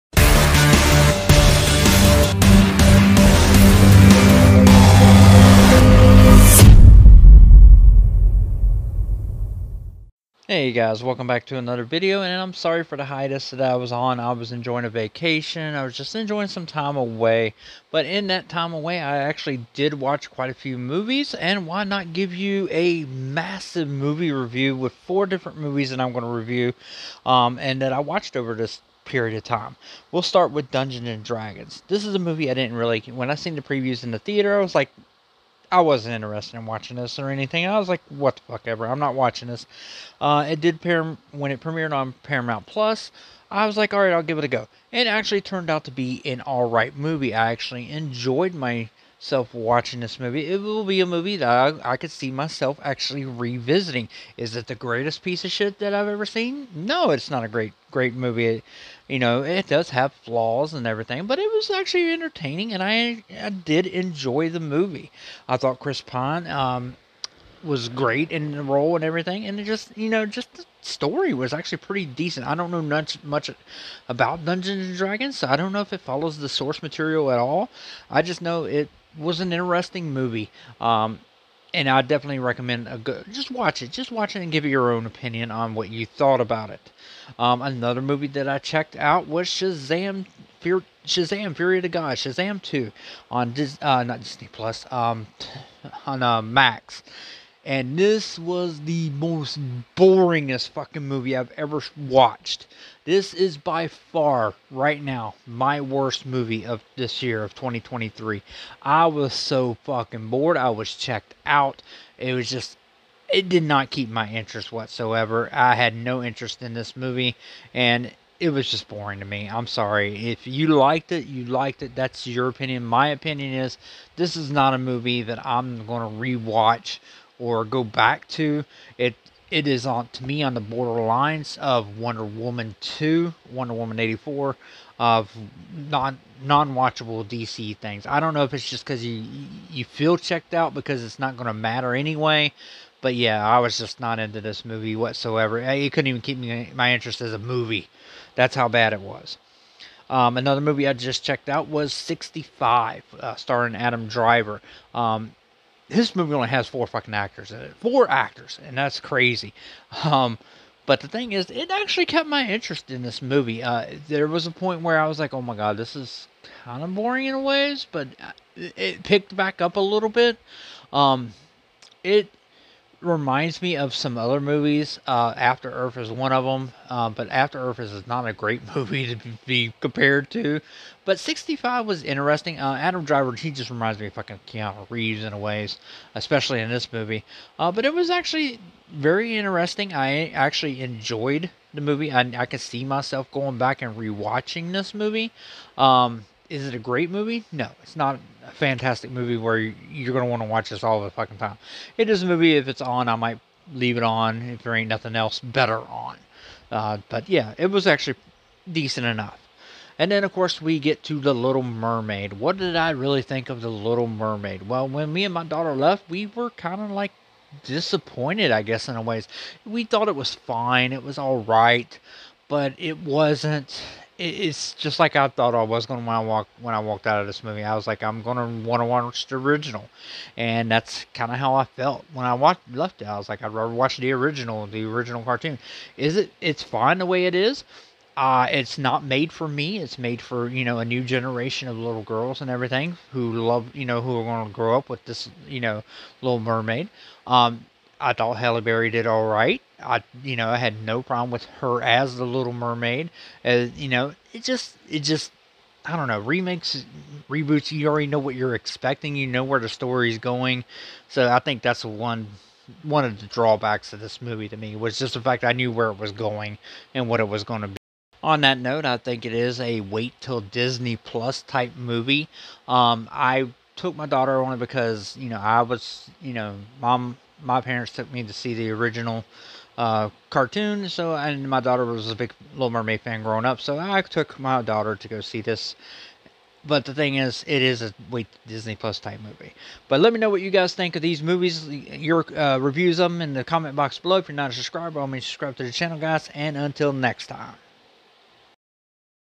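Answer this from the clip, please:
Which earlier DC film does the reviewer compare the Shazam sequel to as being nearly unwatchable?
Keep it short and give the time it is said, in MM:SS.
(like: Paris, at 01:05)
Wonder Woman 84, at 02:13.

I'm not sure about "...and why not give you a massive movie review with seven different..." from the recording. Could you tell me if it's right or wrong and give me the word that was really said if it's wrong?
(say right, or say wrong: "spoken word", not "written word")
wrong: "four", not "seven".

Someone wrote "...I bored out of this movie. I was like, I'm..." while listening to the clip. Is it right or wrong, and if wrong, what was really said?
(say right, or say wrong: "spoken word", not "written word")
wrong: "walked", not "bored".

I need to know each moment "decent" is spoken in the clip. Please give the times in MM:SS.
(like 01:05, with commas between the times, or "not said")
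01:12, 03:28.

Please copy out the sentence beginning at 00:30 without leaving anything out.
We'll start with Dungeons and Dragons.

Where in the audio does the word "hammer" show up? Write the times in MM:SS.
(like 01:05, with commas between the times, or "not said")
not said.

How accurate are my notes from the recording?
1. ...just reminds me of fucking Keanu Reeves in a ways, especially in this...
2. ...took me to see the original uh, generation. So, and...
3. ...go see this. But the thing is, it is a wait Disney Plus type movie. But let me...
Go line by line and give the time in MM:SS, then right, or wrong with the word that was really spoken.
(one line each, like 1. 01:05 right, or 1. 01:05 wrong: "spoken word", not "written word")
1. 03:03 right
2. 04:37 wrong: "cartoon", not "generation"
3. 04:45 right.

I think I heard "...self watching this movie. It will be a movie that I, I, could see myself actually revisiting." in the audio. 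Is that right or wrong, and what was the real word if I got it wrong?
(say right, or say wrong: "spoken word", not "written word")
right.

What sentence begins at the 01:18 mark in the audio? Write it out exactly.
I just know it was an interesting movie.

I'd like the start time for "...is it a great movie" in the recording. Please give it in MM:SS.
03:16.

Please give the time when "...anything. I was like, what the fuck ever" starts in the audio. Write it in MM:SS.
00:37.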